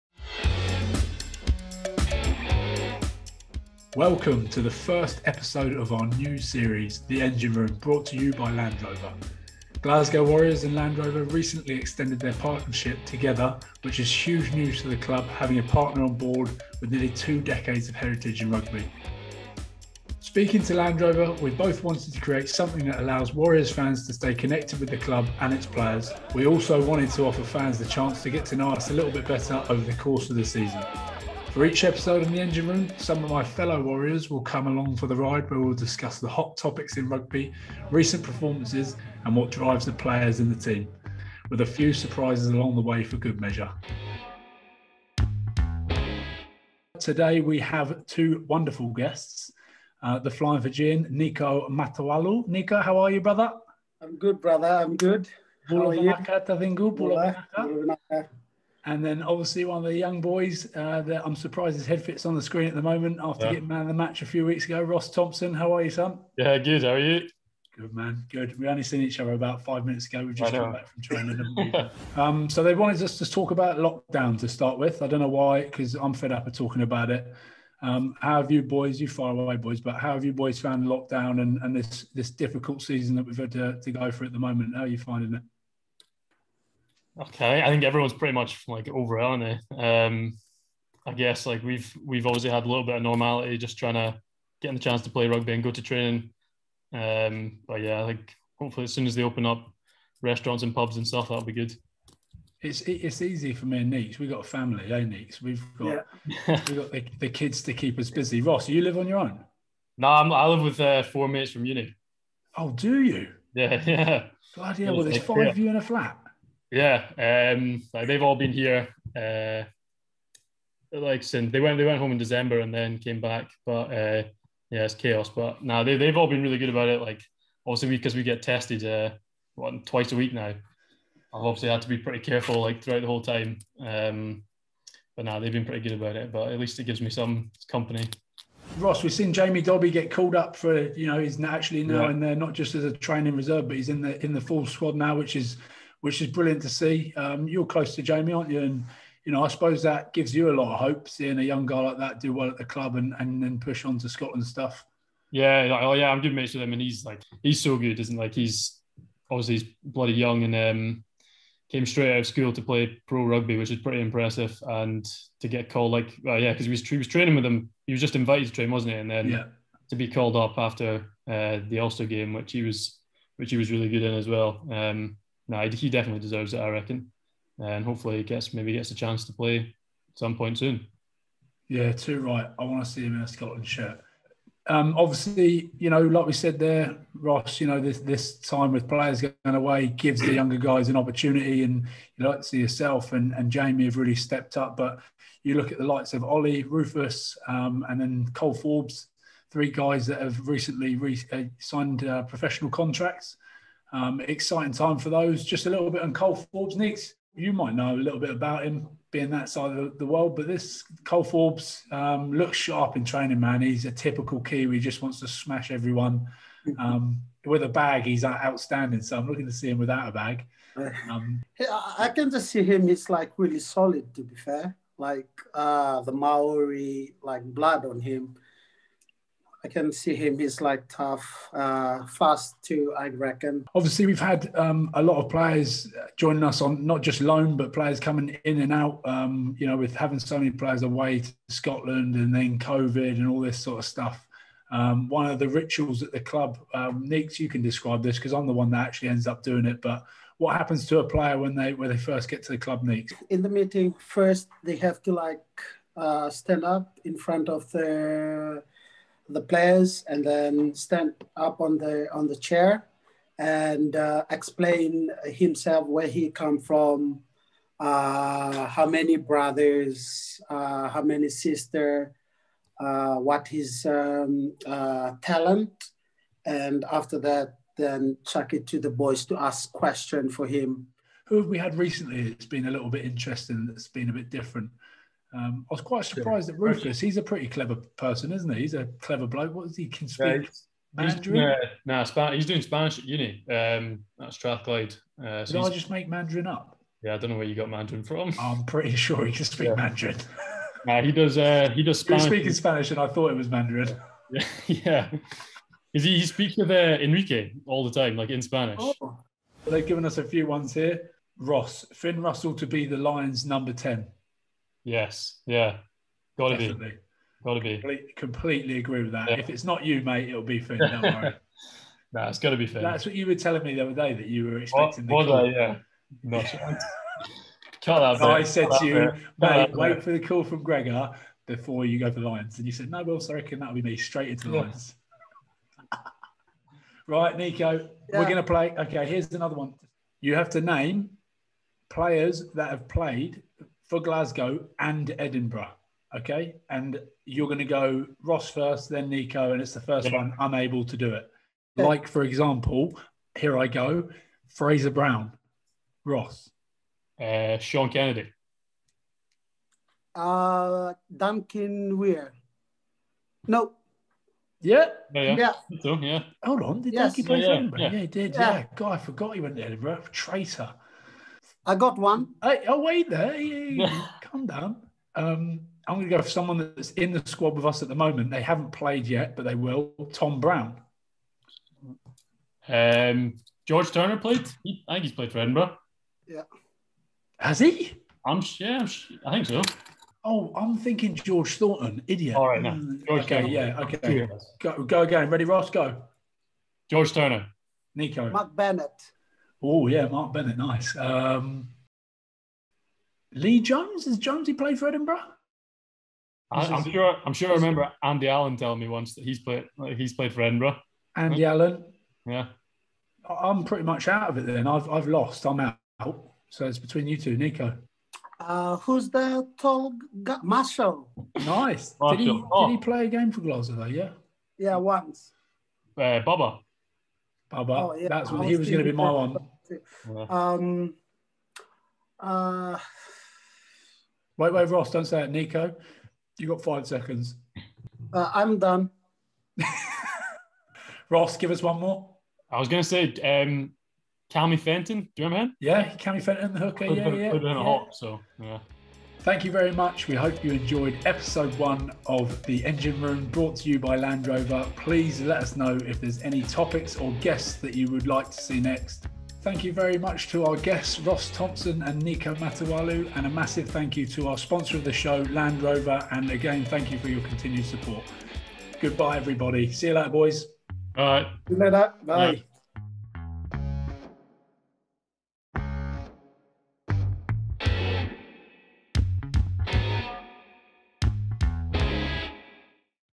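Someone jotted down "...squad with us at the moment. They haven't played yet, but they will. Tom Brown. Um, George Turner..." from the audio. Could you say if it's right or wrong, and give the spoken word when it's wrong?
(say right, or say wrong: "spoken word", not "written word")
right.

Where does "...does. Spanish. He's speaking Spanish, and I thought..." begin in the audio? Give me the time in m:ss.
5:01.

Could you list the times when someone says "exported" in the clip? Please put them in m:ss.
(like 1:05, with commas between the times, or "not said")
not said.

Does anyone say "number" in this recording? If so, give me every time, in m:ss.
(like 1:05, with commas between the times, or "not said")
5:13.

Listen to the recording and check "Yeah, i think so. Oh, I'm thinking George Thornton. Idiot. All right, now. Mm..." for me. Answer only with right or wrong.
right.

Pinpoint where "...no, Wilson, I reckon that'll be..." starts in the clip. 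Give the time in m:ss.
5:32.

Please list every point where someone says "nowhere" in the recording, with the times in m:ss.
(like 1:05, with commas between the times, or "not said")
not said.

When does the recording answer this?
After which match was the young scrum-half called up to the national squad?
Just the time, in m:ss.
2:51.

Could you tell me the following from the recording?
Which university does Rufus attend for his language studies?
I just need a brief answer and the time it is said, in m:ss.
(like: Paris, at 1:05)
Strathclyde, at 4:54.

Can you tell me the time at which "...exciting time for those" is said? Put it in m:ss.
3:24.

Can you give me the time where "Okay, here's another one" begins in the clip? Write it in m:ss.
5:38.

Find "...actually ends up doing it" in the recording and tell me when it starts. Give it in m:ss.
4:08.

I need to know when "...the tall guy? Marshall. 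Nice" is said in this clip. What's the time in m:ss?
6:59.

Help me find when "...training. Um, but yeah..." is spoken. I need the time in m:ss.
1:35.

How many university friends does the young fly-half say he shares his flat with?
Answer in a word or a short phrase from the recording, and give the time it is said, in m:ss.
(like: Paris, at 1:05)
4, at 1:51.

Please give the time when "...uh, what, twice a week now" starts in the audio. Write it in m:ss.
2:08.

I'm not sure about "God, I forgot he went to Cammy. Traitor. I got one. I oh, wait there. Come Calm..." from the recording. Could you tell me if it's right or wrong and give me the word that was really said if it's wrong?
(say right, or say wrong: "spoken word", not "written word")
wrong: "Edinburgh", not "Cammy".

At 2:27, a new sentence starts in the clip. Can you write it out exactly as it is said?
Um, you're close to Jamie, aren't you?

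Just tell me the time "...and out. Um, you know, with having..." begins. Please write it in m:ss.
3:58.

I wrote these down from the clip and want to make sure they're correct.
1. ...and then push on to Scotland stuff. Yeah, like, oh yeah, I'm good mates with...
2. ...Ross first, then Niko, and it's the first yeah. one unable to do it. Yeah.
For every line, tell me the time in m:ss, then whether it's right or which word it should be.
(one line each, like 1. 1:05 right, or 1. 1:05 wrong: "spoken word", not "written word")
1. 2:33 right
2. 5:48 right.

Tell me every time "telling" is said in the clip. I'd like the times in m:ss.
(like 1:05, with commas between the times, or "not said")
5:23, 6:48.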